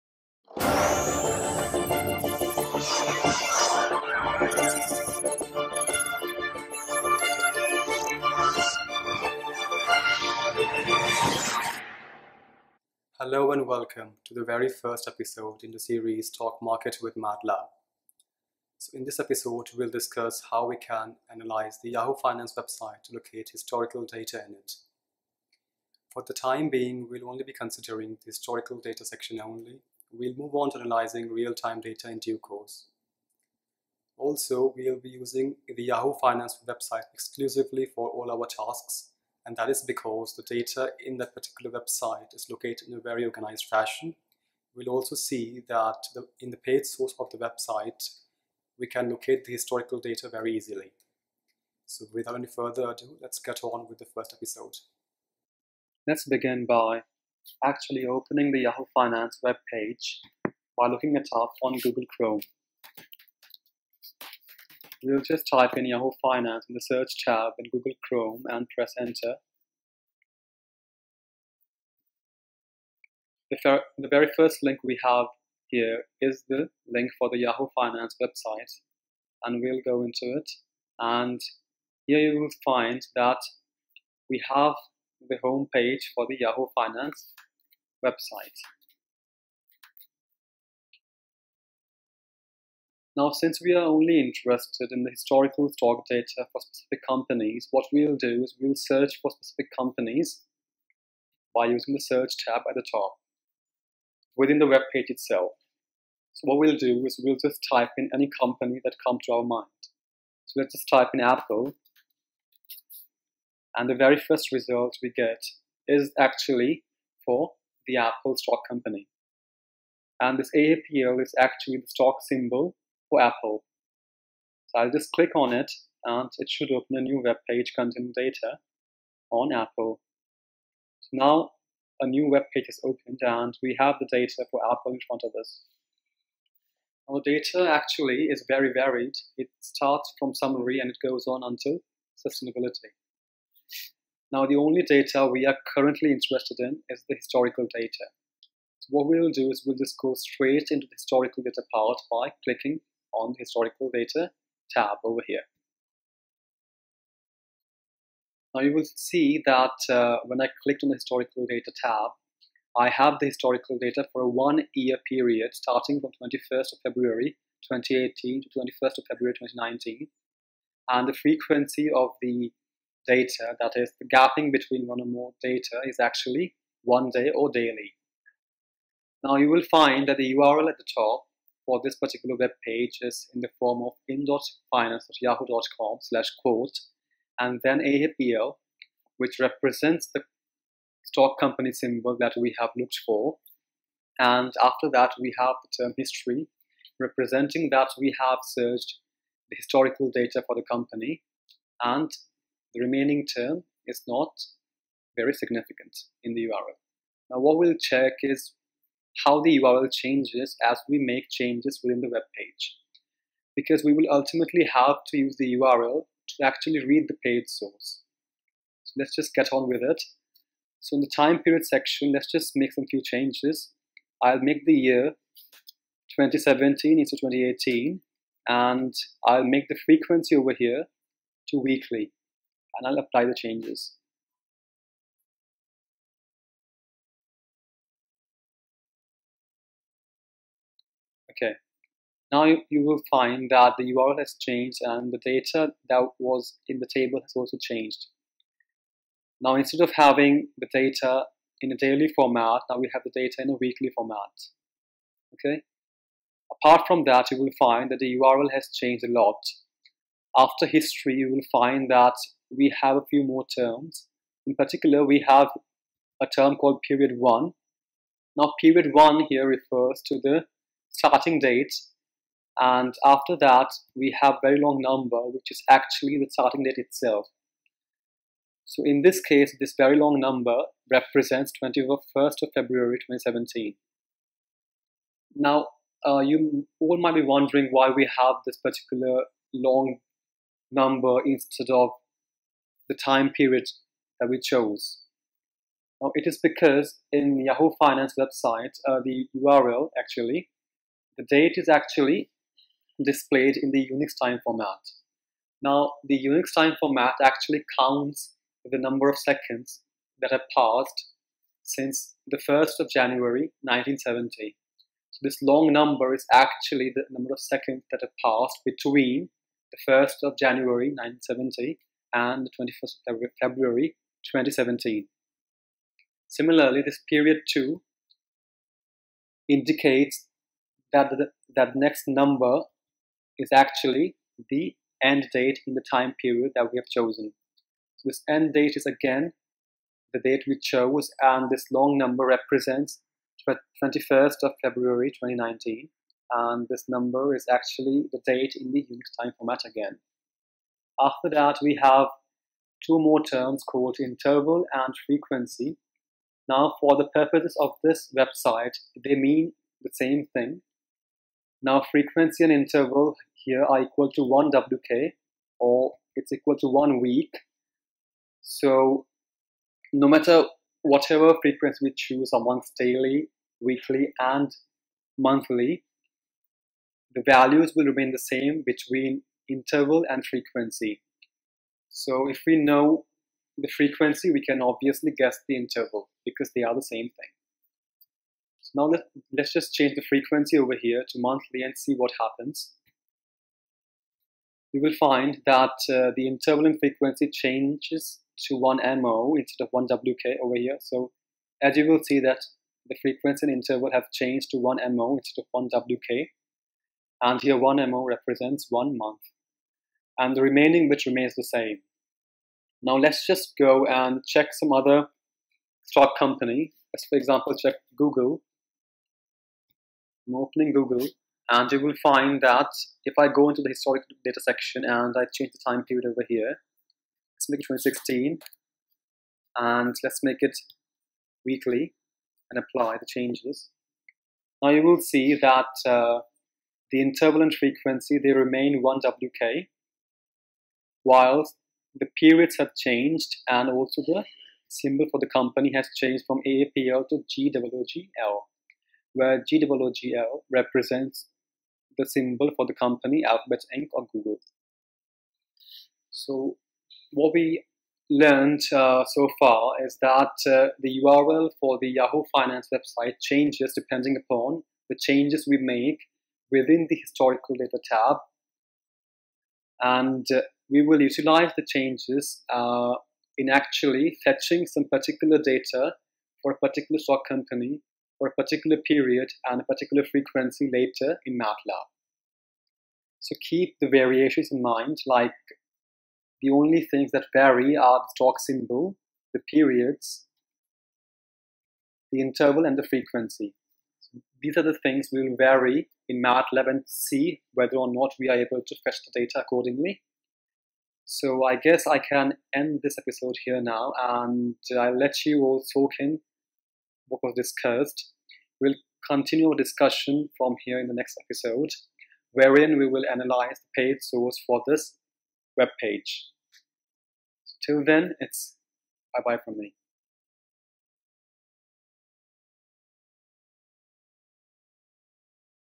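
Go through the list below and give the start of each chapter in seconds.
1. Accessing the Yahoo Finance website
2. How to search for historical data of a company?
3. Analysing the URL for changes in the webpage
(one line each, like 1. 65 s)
1. 55 s
2. 90 s
3. 158 s.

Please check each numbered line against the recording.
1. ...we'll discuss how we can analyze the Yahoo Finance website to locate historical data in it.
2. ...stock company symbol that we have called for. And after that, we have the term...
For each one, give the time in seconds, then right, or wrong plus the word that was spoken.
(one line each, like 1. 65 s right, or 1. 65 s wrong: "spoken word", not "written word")
1. 19 s right
2. 191 s wrong: "looked", not "called".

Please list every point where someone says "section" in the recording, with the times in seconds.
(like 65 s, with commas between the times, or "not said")
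29 s, 221 s, 424 s.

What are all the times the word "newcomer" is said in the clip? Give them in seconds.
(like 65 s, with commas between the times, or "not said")
not said.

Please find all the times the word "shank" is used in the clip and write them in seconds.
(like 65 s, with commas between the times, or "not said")
not said.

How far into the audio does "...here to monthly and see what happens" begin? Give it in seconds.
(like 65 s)
390 s.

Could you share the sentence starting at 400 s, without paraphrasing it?
So as you will see that the frequency and interval have changed to 1 MO instead of 1 WK.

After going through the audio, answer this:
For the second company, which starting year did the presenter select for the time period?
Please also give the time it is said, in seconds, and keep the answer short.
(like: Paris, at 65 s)
2016, at 427 s.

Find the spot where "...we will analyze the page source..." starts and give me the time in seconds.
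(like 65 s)
512 s.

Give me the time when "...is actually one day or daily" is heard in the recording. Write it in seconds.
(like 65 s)
175 s.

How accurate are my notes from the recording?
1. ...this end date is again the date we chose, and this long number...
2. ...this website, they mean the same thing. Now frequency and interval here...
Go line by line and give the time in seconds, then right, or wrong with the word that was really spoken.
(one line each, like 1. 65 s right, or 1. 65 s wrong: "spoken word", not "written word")
1. 338 s right
2. 357 s right.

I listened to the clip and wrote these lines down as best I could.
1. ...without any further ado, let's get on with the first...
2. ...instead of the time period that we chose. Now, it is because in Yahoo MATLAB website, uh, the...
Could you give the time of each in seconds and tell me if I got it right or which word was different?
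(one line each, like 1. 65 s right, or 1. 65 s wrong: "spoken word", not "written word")
1. 52 s right
2. 291 s wrong: "Finance", not "MATLAB".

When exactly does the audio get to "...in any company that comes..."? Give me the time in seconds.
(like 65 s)
107 s.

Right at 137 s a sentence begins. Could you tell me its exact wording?
Our data actually is very varied.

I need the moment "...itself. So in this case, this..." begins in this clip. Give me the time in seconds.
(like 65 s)
276 s.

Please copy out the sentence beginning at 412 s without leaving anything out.
Now let's just go and check some other stock company.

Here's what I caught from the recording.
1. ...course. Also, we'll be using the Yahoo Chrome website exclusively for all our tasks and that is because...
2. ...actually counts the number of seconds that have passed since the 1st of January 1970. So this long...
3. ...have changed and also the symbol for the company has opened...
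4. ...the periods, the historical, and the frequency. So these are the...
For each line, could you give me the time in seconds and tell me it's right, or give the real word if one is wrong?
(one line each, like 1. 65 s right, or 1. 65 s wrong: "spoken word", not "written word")
1. 32 s wrong: "Finance", not "Chrome"
2. 307 s right
3. 442 s wrong: "changed", not "opened"
4. 489 s wrong: "interval", not "historical".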